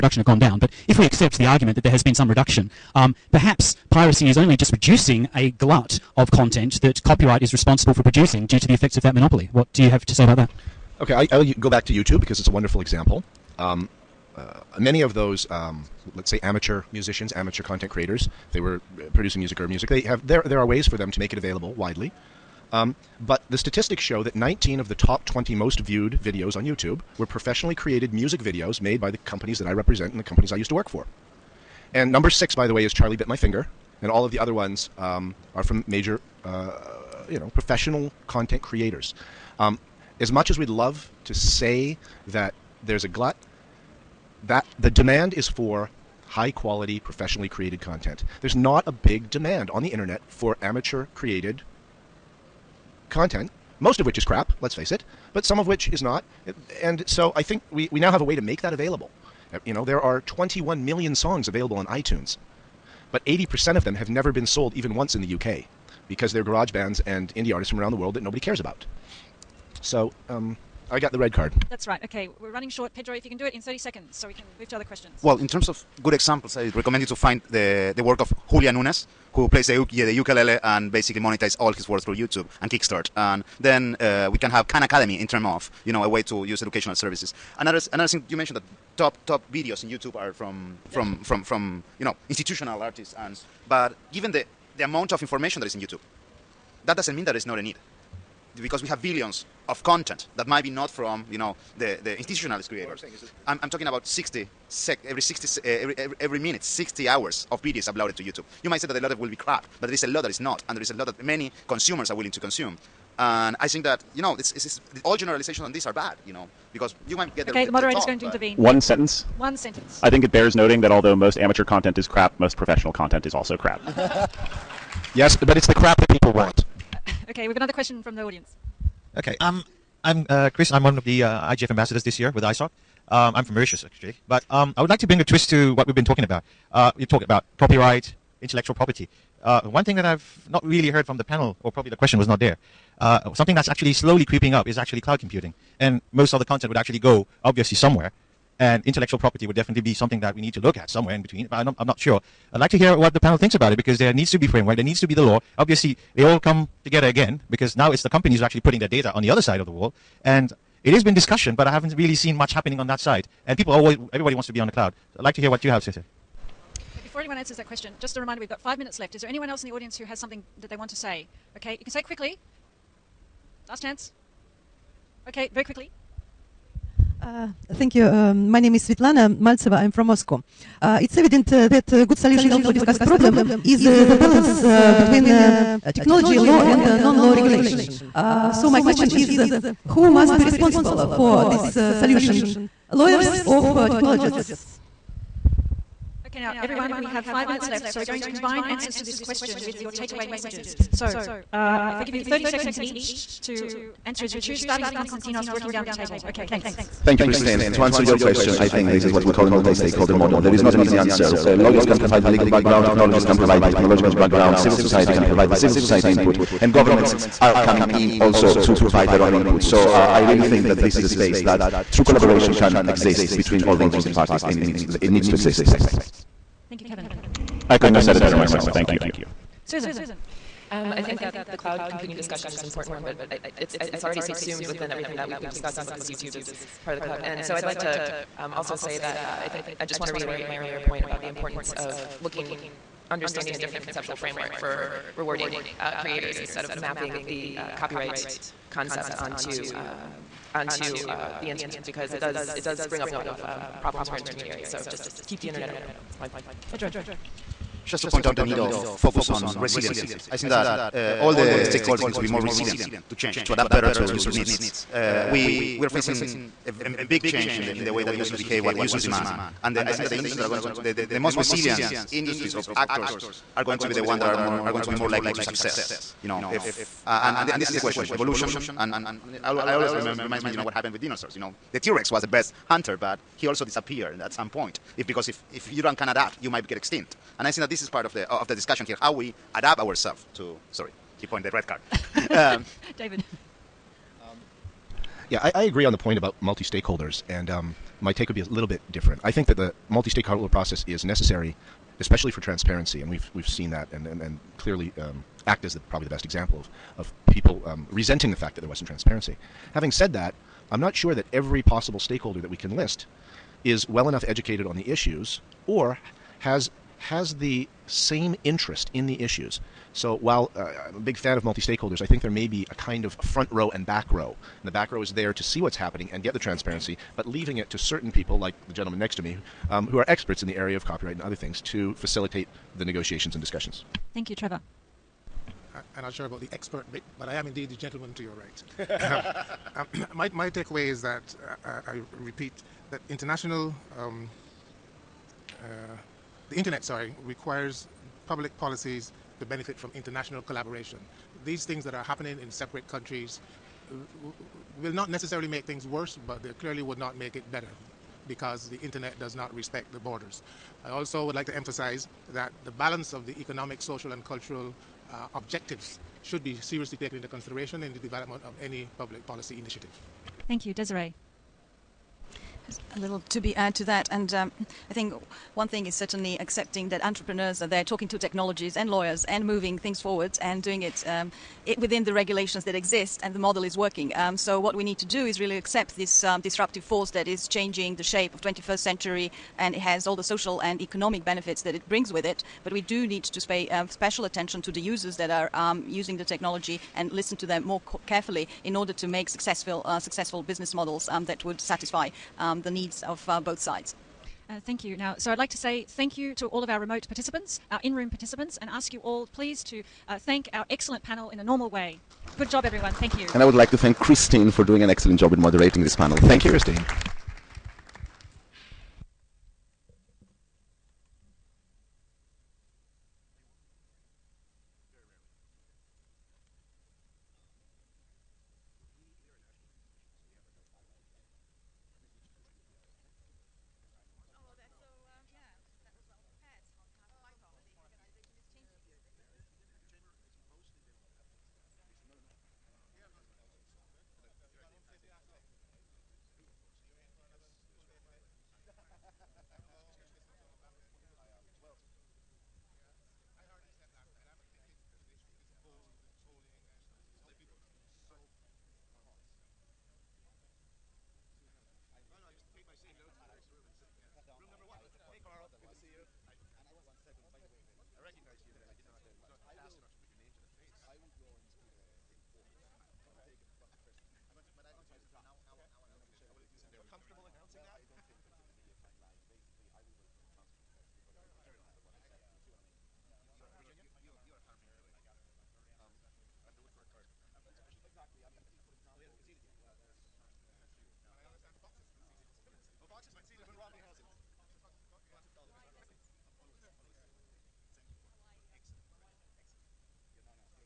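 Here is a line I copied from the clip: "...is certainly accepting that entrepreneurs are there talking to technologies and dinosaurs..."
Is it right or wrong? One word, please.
wrong.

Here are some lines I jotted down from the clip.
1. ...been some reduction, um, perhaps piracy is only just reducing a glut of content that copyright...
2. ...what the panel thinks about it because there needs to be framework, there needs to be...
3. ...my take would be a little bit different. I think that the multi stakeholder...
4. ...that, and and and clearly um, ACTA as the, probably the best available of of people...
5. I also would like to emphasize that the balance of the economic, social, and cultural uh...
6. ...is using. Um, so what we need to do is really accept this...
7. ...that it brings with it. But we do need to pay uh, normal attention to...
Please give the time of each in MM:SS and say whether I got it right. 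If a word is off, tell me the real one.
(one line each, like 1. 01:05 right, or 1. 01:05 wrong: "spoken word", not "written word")
1. 00:02 right
2. 02:32 right
3. 04:58 right
4. 05:03 wrong: "example", not "available"
5. 06:00 right
6. 06:23 wrong: "working", not "using"
7. 06:31 wrong: "special", not "normal".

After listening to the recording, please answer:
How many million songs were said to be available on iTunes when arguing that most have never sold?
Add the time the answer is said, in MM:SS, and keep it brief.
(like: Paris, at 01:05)
21 million, at 01:00.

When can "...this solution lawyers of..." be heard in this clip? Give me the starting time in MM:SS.
03:11.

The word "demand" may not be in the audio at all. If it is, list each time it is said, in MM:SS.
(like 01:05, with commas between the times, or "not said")
00:44, 00:49, 04:29.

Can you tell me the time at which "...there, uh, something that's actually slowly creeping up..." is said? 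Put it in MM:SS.
02:22.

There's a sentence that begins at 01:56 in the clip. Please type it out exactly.
You know because you might get the Okay, the, the moderator is going to intervene.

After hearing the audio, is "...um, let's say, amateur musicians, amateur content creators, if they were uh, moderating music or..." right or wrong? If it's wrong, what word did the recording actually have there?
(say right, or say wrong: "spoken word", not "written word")
wrong: "producing", not "moderating".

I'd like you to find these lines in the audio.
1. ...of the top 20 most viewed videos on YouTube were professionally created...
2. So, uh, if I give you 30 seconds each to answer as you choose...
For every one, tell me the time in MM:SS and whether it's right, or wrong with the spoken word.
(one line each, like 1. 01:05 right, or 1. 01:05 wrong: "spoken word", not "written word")
1. 00:24 right
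2. 03:20 right.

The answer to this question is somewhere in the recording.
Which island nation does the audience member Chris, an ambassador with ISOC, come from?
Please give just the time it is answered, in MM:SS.
02:13.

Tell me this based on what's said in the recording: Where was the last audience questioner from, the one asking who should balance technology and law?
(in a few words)
Moscow.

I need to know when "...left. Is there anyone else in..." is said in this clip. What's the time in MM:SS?
02:48.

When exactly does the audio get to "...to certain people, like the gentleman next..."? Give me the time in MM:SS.
05:27.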